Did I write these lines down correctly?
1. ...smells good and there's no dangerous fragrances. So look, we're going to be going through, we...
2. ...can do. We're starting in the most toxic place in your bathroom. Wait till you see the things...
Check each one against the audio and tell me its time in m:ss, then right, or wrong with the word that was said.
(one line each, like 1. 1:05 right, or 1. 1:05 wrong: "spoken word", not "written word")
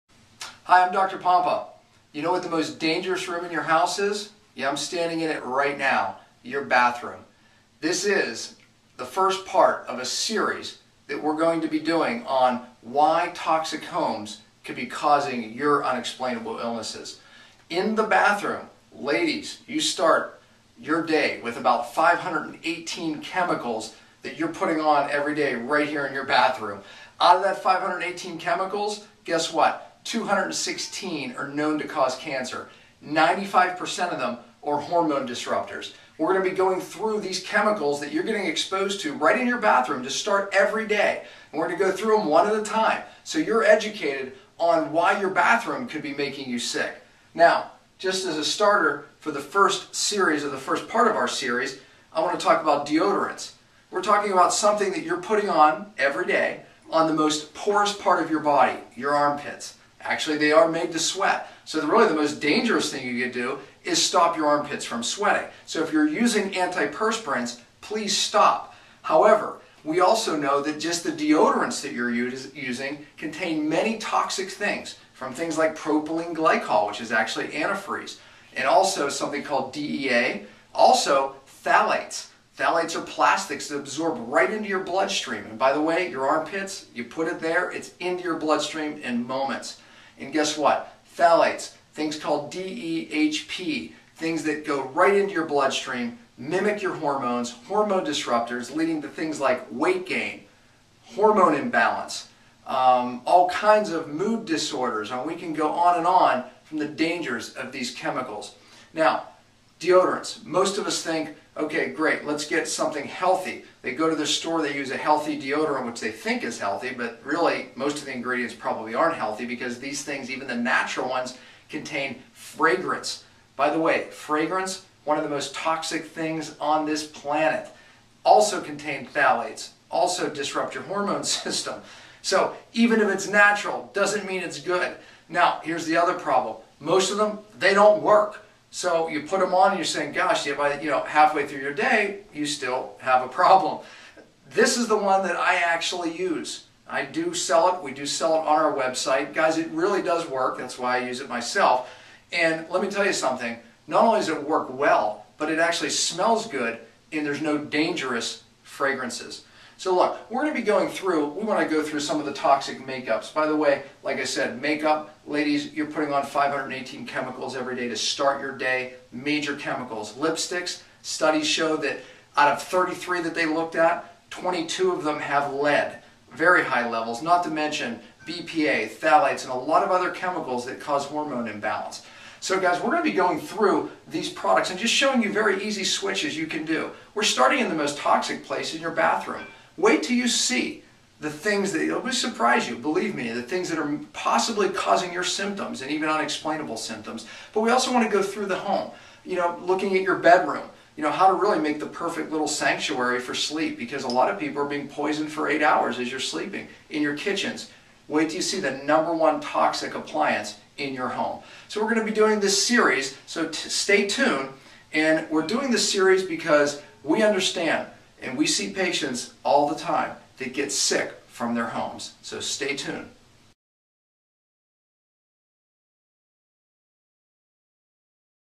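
1. 2:35 right
2. 3:06 right.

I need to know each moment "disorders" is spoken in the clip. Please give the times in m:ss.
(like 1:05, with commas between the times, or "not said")
1:44.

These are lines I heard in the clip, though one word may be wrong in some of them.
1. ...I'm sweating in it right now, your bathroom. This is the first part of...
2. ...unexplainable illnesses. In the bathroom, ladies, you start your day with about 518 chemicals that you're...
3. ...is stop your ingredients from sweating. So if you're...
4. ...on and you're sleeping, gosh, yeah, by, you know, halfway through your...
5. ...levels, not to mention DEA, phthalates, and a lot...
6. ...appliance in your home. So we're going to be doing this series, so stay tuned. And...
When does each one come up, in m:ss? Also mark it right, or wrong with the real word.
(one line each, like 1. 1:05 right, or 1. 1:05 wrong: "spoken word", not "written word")
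1. 0:04 wrong: "standing", not "sweating"
2. 0:15 right
3. 1:03 wrong: "armpits", not "ingredients"
4. 2:19 wrong: "saying", not "sleeping"
5. 2:56 wrong: "BPA", not "DEA"
6. 3:29 right.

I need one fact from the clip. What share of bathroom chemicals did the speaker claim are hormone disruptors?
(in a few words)
95%.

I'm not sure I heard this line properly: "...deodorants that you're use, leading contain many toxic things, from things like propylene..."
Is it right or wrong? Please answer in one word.
wrong.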